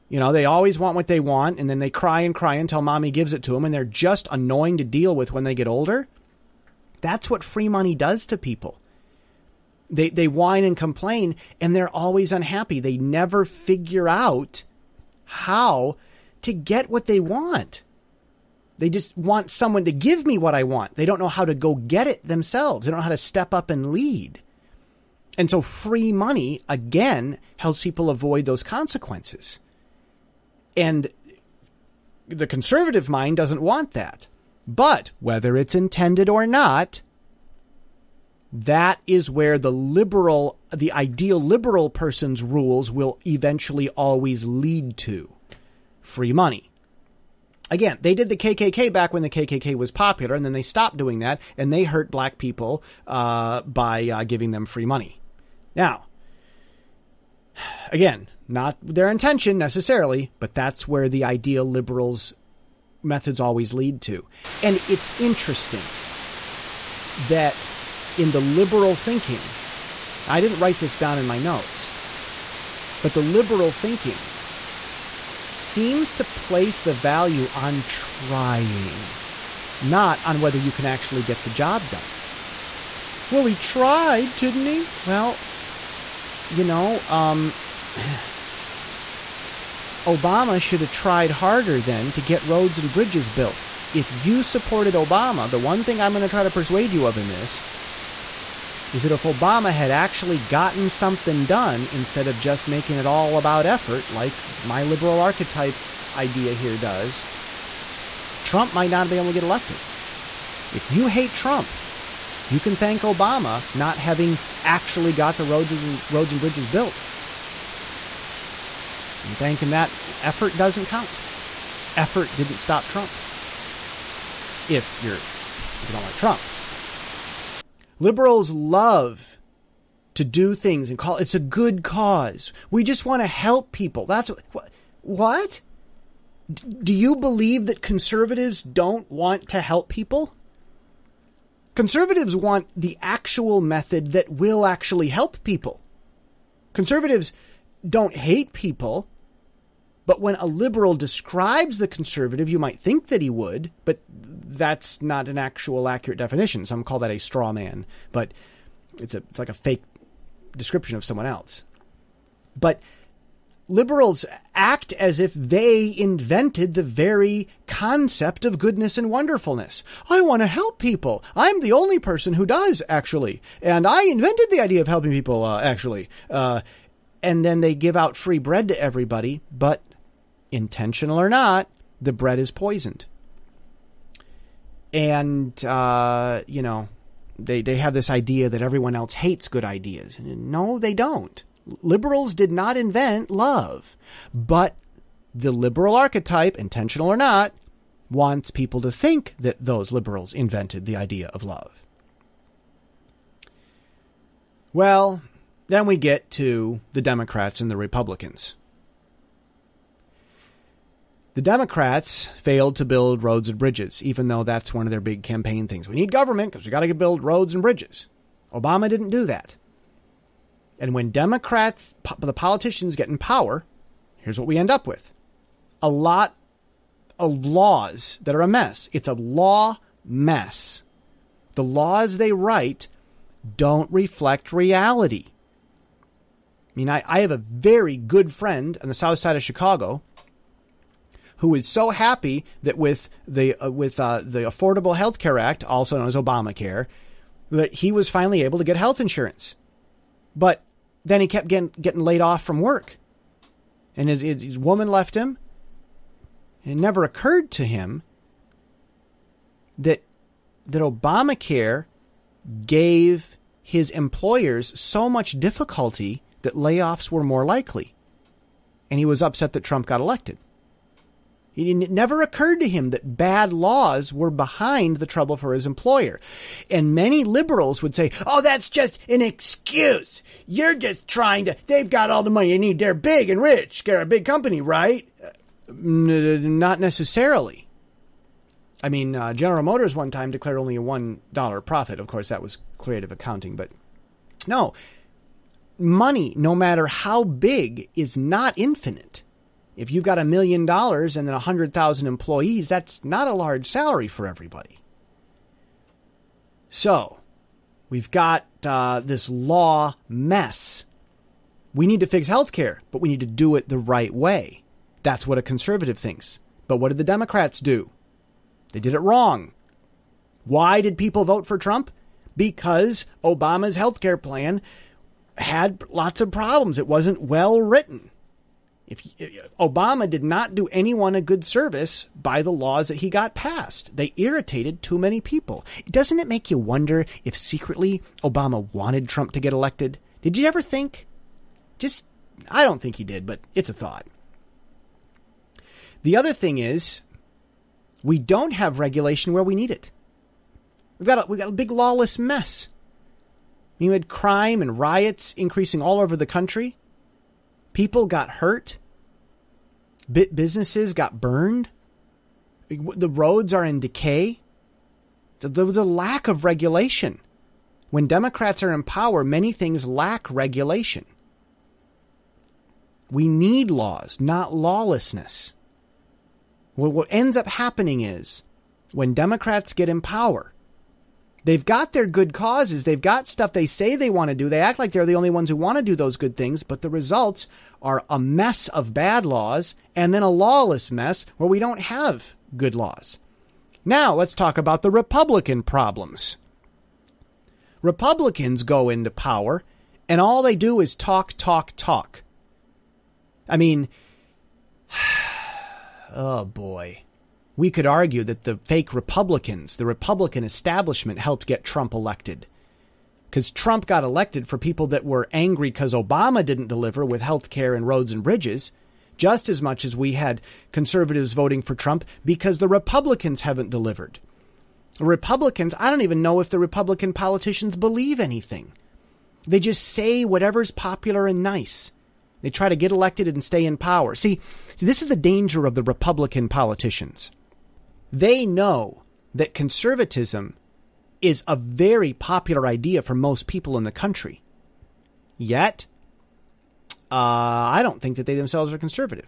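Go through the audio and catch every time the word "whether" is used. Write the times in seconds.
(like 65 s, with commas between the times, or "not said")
35 s, 80 s.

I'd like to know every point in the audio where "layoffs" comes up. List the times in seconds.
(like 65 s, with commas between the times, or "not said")
266 s.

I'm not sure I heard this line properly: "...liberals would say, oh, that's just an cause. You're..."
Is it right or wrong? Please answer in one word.
wrong.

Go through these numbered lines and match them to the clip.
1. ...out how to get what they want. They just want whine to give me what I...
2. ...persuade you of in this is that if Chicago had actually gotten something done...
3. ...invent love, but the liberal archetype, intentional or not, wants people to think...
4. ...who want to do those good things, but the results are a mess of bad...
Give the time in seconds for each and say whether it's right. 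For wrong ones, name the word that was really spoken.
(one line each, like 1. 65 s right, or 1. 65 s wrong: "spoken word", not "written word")
1. 14 s wrong: "someone", not "whine"
2. 96 s wrong: "Obama", not "Chicago"
3. 192 s right
4. 385 s right.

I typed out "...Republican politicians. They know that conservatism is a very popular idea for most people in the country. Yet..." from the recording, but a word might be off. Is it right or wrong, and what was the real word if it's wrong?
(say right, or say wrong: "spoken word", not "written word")
right.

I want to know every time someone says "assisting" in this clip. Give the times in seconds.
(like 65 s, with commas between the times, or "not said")
not said.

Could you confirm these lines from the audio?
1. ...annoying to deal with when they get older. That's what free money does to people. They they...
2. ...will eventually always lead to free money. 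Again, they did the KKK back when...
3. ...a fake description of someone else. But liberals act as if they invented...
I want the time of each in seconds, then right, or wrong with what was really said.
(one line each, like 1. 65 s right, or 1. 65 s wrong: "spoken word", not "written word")
1. 4 s right
2. 42 s right
3. 159 s right.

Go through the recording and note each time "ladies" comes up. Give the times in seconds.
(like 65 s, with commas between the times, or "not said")
not said.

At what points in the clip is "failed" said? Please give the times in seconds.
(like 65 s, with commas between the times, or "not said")
212 s.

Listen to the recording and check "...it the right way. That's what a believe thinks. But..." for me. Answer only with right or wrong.
wrong.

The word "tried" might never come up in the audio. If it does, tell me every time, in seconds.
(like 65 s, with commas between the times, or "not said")
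83 s, 90 s.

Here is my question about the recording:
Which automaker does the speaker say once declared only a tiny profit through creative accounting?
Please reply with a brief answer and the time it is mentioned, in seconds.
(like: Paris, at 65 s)
General Motors, at 289 s.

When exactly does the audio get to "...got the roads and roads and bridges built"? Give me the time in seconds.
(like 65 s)
115 s.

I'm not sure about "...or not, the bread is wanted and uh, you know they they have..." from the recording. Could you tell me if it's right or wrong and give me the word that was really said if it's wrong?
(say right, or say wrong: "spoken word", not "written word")
wrong: "poisoned", not "wanted".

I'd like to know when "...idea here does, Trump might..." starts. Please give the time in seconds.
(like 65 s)
106 s.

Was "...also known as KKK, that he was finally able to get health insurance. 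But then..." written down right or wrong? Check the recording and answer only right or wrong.
wrong.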